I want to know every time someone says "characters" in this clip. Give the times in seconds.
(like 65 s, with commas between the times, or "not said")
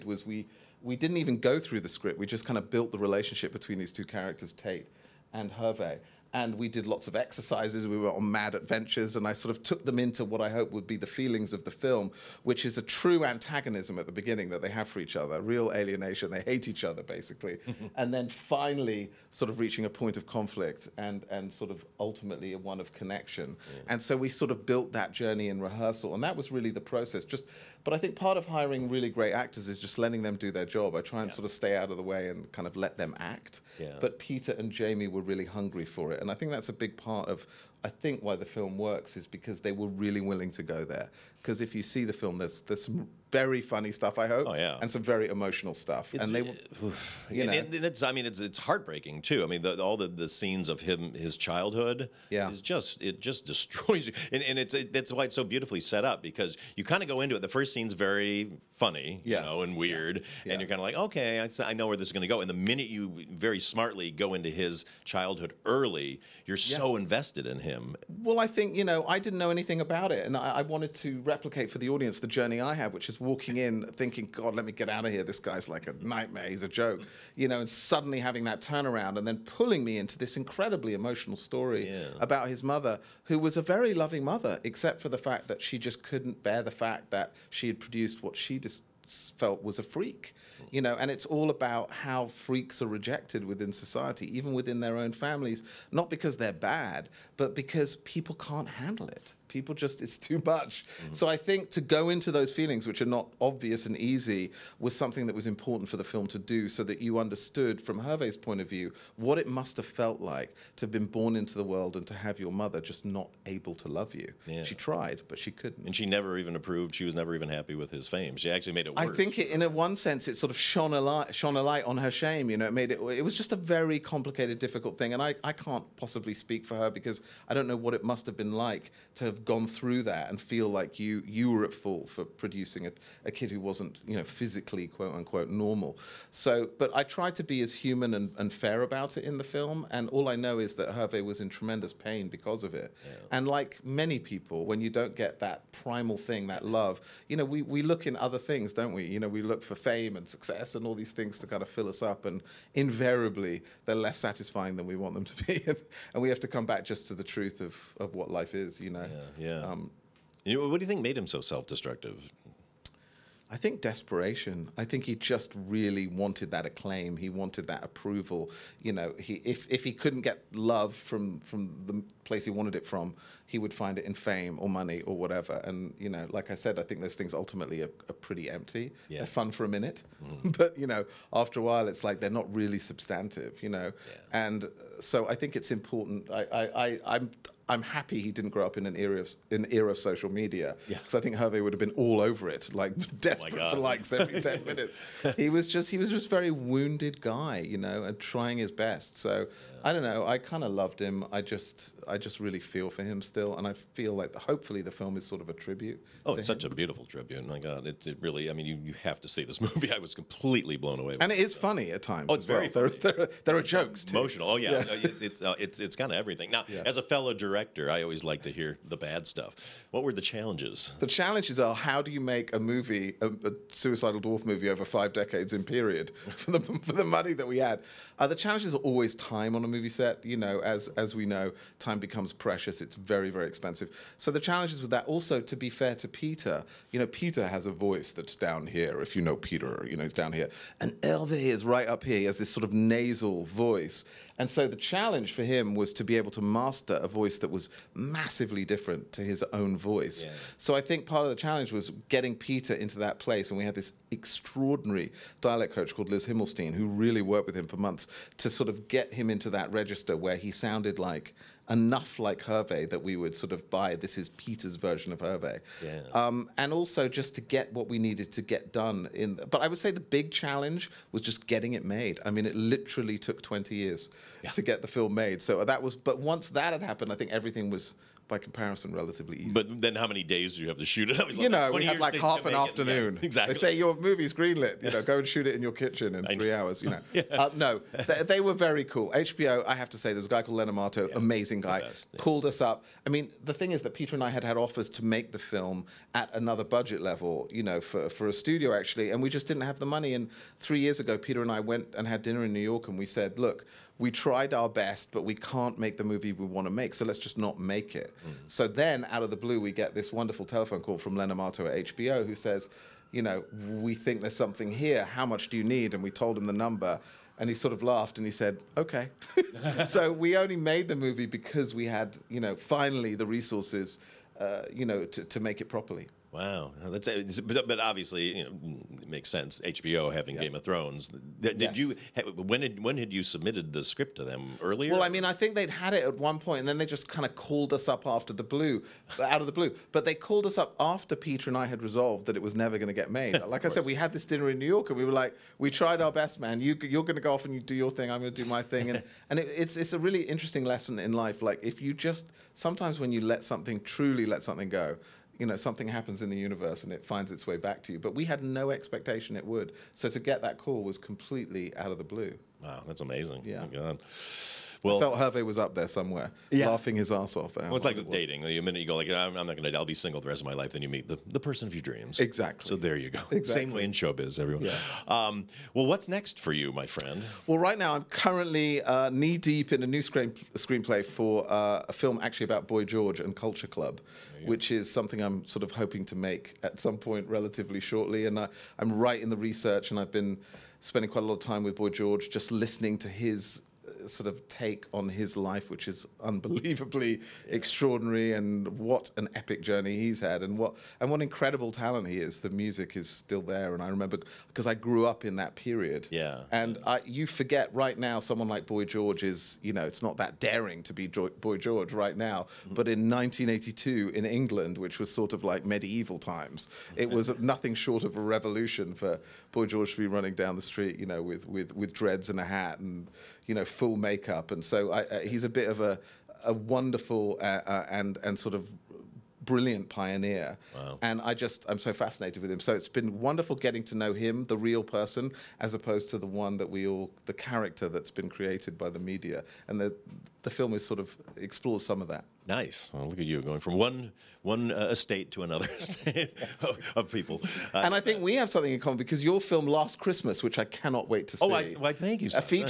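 4 s, 437 s.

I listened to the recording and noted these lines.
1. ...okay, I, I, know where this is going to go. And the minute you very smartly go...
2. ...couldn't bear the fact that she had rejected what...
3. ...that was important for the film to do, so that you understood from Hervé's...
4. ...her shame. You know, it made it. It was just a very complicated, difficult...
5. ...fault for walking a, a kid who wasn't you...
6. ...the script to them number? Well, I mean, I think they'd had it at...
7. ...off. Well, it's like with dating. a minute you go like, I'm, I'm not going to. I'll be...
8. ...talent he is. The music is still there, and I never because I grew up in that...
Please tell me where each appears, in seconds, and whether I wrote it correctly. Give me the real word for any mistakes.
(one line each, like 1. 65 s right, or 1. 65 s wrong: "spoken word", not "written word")
1. 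60 s right
2. 86 s wrong: "produced", not "rejected"
3. 105 s right
4. 121 s right
5. 131 s wrong: "producing", not "walking"
6. 333 s wrong: "earlier", not "number"
7. 367 s right
8. 401 s wrong: "remember", not "never".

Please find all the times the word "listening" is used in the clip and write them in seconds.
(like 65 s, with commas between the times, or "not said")
392 s.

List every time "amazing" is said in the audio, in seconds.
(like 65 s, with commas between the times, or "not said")
291 s, 362 s.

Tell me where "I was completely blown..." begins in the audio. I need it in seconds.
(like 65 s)
209 s.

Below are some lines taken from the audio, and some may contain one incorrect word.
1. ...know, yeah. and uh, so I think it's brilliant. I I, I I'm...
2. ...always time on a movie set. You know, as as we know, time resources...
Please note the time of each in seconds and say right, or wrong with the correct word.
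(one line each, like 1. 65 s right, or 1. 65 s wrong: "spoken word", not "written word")
1. 183 s wrong: "important", not "brilliant"
2. 228 s wrong: "becomes", not "resources".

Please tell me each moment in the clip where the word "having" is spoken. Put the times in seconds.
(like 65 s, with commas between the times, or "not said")
78 s, 330 s.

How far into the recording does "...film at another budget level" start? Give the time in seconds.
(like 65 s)
295 s.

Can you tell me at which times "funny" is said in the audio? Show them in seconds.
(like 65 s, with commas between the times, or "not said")
43 s, 58 s, 211 s.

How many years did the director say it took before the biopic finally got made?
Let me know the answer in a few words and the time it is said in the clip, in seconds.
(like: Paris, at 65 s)
20, at 273 s.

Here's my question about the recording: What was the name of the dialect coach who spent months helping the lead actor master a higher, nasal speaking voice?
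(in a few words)
Liz Himelstein.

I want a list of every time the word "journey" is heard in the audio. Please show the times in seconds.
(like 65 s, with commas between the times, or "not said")
25 s, 72 s, 399 s.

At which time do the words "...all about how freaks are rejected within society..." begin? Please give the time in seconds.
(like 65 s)
91 s.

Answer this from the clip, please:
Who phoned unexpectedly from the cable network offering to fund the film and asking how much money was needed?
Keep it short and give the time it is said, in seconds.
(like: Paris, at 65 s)
Len Amato, at 311 s.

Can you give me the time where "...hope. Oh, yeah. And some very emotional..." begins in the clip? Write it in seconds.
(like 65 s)
44 s.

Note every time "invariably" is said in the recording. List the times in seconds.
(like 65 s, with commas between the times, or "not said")
152 s.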